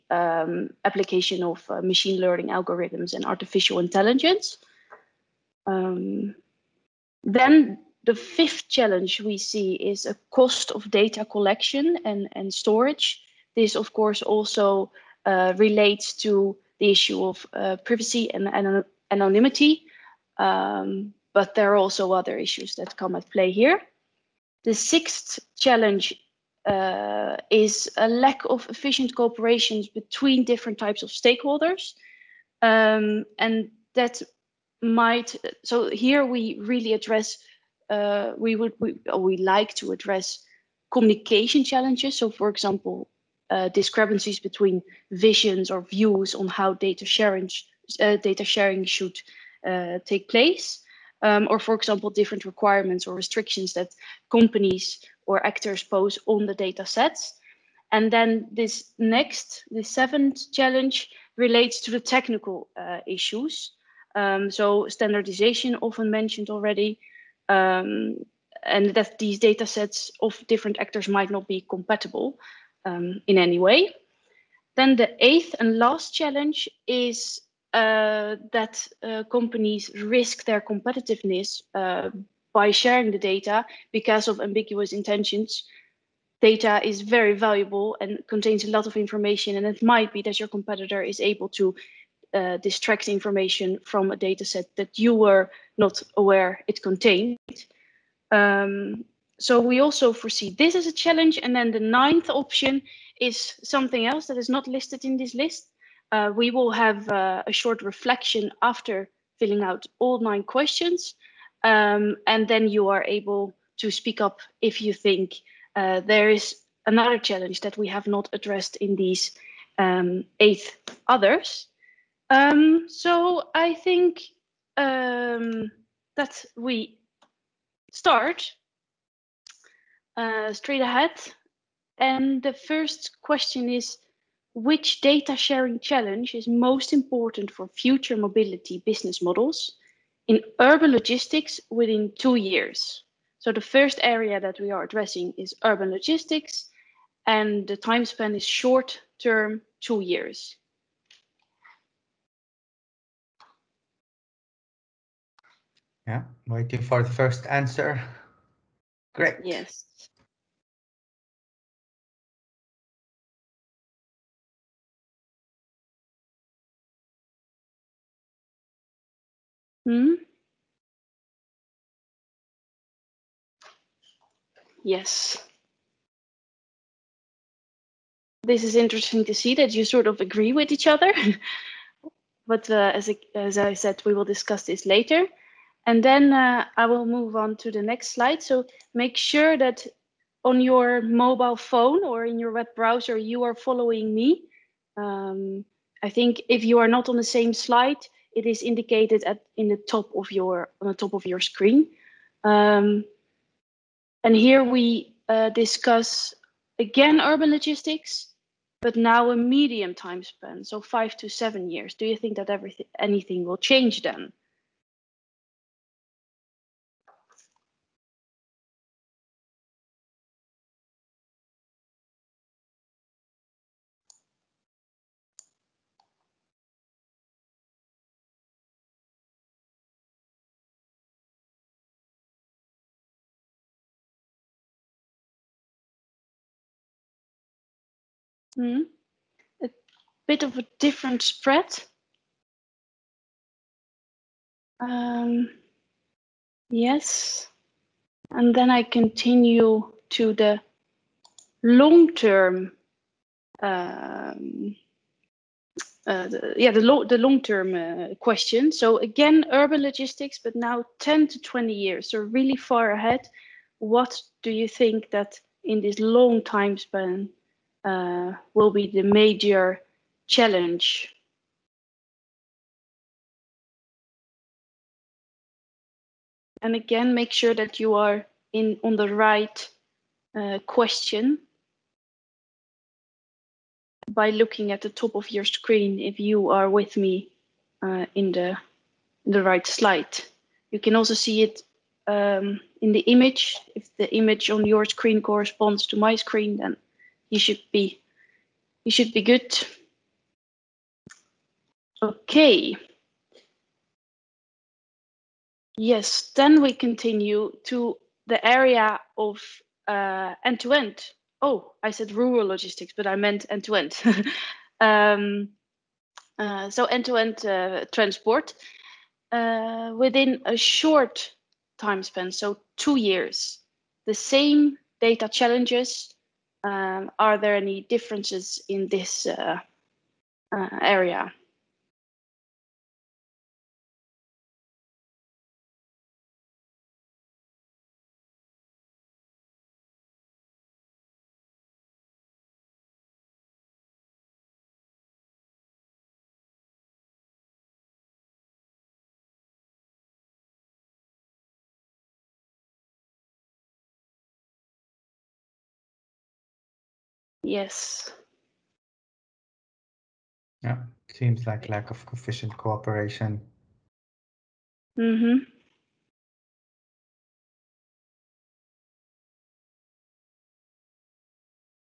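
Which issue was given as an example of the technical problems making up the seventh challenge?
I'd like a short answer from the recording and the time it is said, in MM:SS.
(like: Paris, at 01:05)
Standardization, at 01:04.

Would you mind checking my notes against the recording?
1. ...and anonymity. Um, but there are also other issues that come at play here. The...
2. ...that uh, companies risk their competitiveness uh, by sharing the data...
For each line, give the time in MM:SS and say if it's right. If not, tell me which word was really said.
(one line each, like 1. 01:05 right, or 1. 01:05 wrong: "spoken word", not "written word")
1. 00:18 right
2. 01:18 right.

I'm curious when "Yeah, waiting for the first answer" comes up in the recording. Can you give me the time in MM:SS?
02:36.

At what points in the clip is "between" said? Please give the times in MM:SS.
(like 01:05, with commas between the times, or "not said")
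00:29, 00:44.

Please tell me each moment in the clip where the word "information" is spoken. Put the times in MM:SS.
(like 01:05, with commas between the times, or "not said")
01:28, 01:33.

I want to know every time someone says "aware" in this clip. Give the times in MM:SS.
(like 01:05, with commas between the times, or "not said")
01:36.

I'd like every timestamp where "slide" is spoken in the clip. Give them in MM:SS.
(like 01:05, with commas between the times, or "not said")
03:08, 03:17, 04:49.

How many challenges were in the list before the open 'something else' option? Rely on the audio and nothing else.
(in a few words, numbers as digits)
8.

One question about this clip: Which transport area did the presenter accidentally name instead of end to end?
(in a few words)
Rural logistics.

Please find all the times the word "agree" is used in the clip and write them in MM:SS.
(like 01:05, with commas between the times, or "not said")
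03:00.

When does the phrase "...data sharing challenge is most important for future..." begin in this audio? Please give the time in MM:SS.
02:14.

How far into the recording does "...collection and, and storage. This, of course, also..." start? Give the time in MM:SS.
00:11.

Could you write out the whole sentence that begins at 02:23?
So the first area that we are addressing is urban logistics, and the time span is short term, two years.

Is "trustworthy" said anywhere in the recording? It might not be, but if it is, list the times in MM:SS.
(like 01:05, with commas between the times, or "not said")
not said.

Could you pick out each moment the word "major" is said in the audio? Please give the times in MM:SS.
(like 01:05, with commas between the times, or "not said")
04:29.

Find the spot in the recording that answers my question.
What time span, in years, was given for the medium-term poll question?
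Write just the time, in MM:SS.
03:30.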